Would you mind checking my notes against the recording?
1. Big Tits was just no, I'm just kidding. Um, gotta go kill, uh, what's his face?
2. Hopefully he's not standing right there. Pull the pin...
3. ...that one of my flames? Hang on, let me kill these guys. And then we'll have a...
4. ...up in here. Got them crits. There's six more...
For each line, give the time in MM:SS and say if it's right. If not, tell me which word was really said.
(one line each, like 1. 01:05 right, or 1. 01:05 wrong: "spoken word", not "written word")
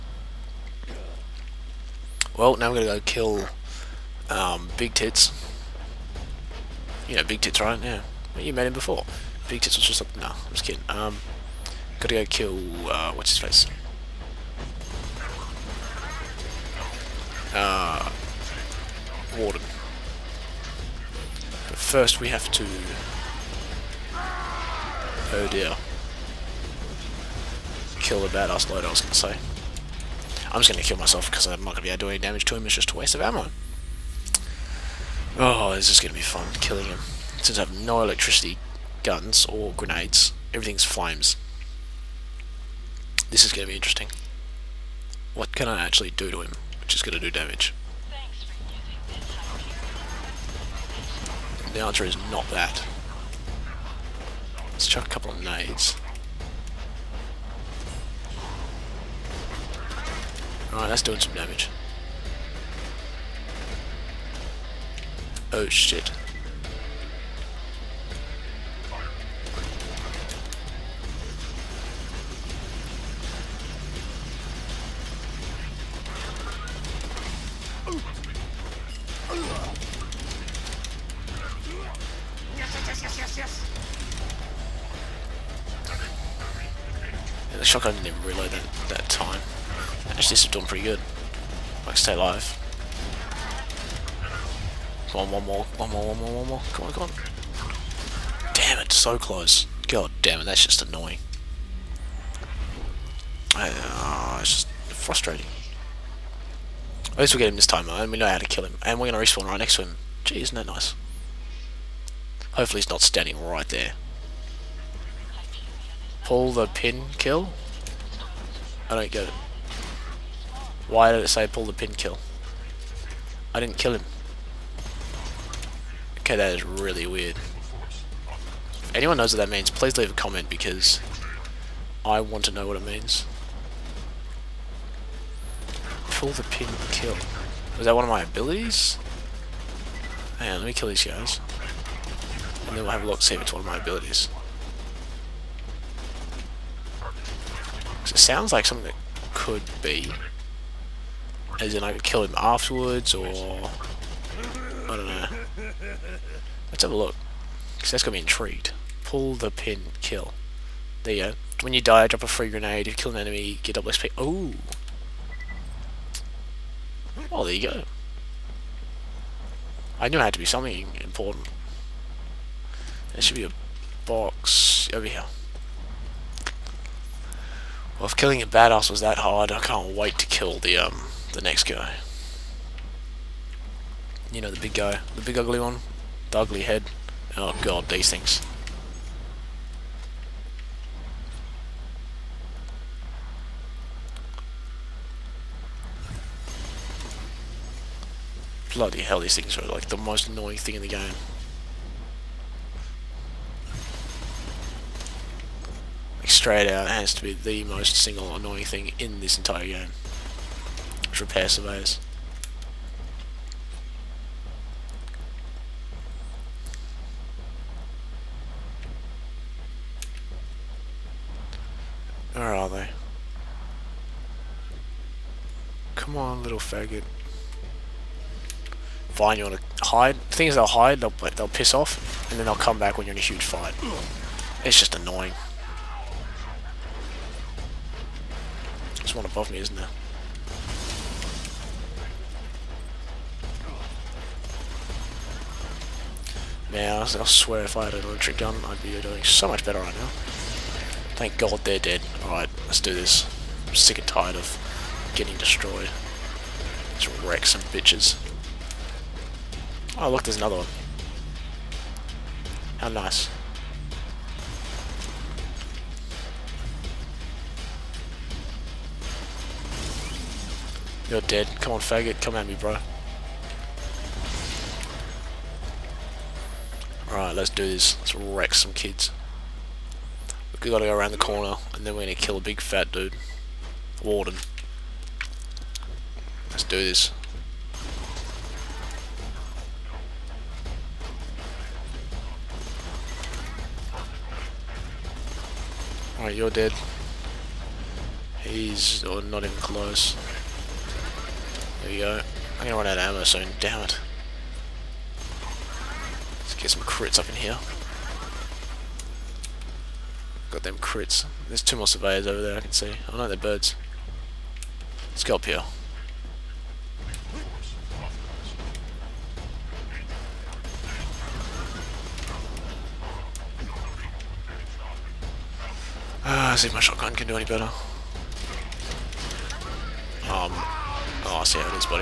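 1. 00:09 right
2. 01:52 right
3. 02:17 wrong: "abilities", not "flames"
4. 05:07 wrong: "two", not "six".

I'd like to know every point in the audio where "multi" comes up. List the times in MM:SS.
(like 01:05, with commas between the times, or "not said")
not said.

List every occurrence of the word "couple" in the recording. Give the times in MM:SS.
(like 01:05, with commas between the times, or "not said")
00:55.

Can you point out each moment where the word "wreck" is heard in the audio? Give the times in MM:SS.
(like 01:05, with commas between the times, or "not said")
04:17, 04:38.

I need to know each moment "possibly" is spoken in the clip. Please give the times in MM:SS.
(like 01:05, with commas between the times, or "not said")
not said.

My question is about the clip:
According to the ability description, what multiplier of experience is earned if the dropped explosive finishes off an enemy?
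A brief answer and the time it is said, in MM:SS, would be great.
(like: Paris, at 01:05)
double XP, at 02:43.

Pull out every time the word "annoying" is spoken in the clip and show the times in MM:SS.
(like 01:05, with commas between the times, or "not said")
01:40, 03:20, 03:28, 03:54.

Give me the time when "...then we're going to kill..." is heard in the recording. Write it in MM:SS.
04:41.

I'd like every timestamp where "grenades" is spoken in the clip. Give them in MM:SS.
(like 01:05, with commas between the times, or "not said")
00:39, 02:42.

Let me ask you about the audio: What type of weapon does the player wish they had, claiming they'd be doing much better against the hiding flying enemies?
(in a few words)
electric gun.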